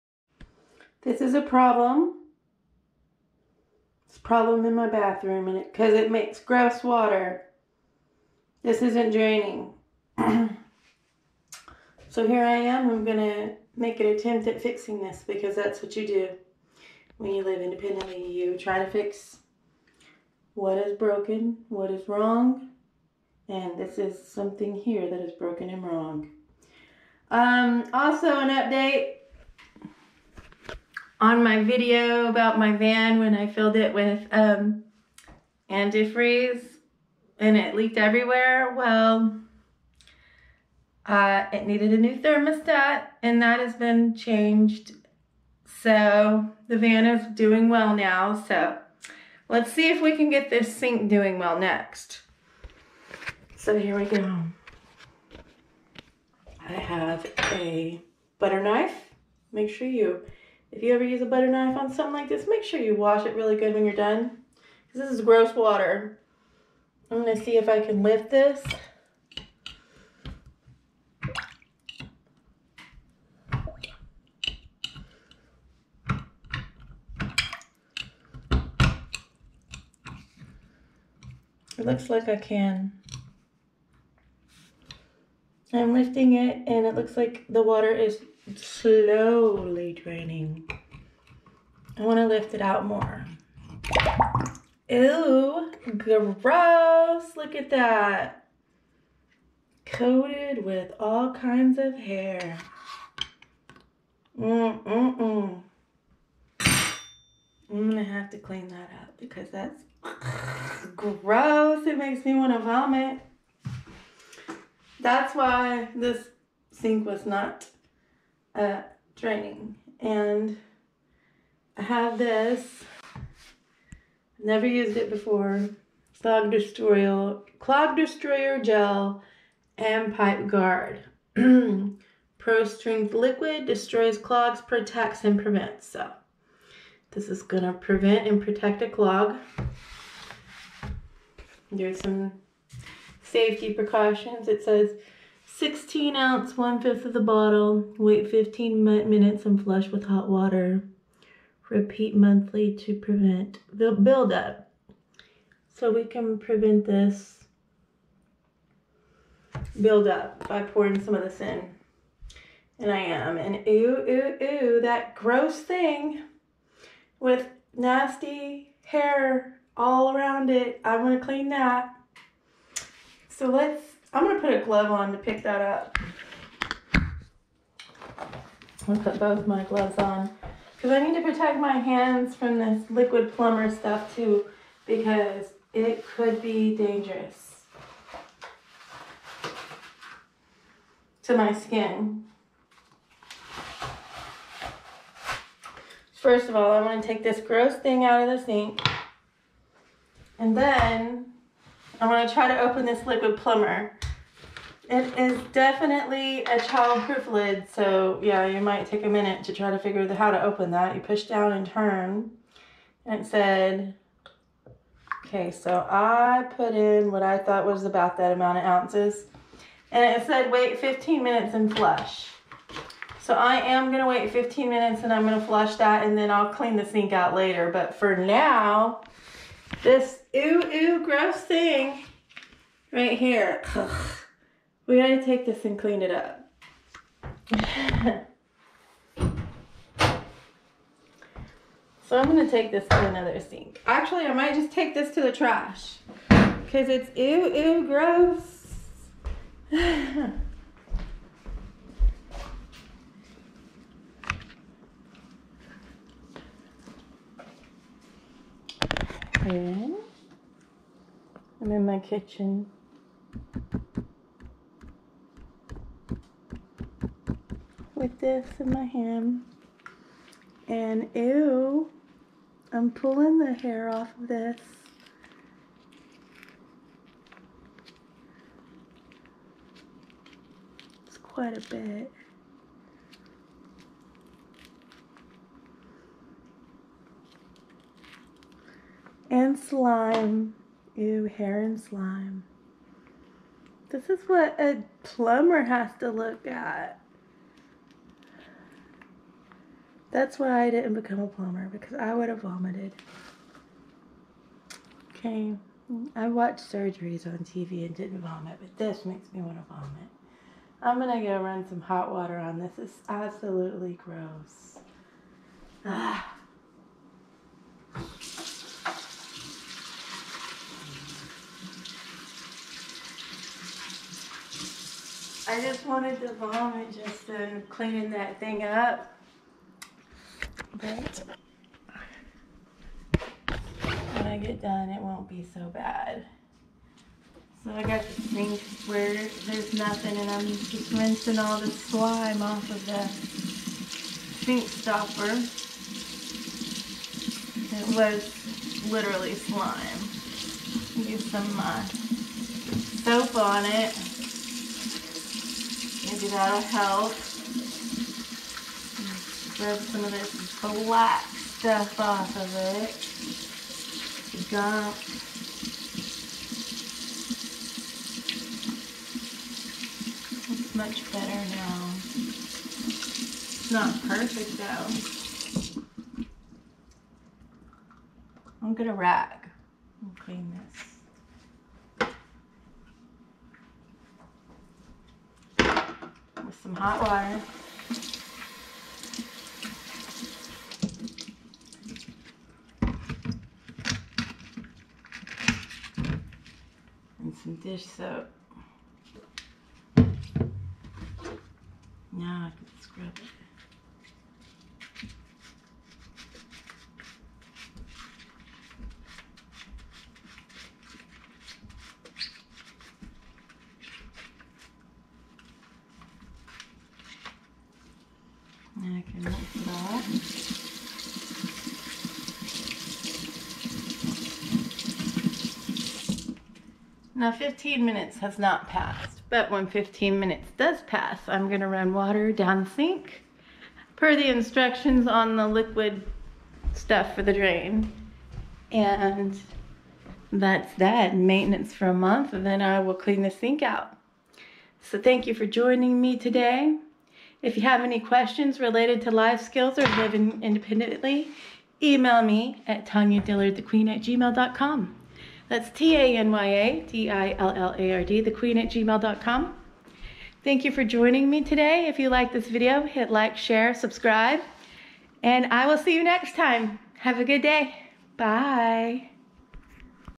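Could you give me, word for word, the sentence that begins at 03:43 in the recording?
So I am gonna wait 15 minutes and I'm gonna flush that and then I'll clean the sink out later.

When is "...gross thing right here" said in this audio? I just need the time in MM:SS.
03:51.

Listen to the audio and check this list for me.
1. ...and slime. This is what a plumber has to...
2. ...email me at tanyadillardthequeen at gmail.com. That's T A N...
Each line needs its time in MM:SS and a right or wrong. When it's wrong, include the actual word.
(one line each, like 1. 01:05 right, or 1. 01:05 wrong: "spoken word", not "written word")
1. 04:51 right
2. 07:31 right.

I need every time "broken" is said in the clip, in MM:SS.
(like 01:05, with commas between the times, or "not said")
00:20, 00:25.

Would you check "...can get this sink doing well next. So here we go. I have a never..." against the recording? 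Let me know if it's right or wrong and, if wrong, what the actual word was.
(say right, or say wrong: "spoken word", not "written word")
wrong: "butter", not "never".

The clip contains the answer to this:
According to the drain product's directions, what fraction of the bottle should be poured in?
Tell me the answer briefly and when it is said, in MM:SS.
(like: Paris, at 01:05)
1/5, at 02:26.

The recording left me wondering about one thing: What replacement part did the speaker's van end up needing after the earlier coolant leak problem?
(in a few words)
thermostat.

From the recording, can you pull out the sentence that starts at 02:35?
So we can prevent this buildup by pouring some of this in.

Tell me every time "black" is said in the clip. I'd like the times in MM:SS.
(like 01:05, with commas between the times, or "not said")
06:00.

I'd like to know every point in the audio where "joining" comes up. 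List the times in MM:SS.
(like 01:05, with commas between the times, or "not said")
07:25, 07:40.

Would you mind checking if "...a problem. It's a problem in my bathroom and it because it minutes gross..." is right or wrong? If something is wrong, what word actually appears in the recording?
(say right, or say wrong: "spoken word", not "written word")
wrong: "makes", not "minutes".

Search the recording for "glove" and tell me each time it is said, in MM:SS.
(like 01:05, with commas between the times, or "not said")
02:54, 02:59.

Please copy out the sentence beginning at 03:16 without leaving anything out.
First of all, I want to take this gross thing out of the sink.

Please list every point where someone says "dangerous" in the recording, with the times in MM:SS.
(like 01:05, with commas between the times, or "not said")
03:06.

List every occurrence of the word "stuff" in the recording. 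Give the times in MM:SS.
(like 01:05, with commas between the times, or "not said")
03:03, 06:01, 07:16.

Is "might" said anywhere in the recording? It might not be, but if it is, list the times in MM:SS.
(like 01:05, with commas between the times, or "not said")
03:28, 04:04.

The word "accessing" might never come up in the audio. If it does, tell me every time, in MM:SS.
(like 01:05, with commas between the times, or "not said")
not said.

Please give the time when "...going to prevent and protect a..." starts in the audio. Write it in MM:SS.
02:17.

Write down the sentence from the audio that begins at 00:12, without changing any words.
I'm gonna make an attempt at fixing this because that's what you do when you live independently.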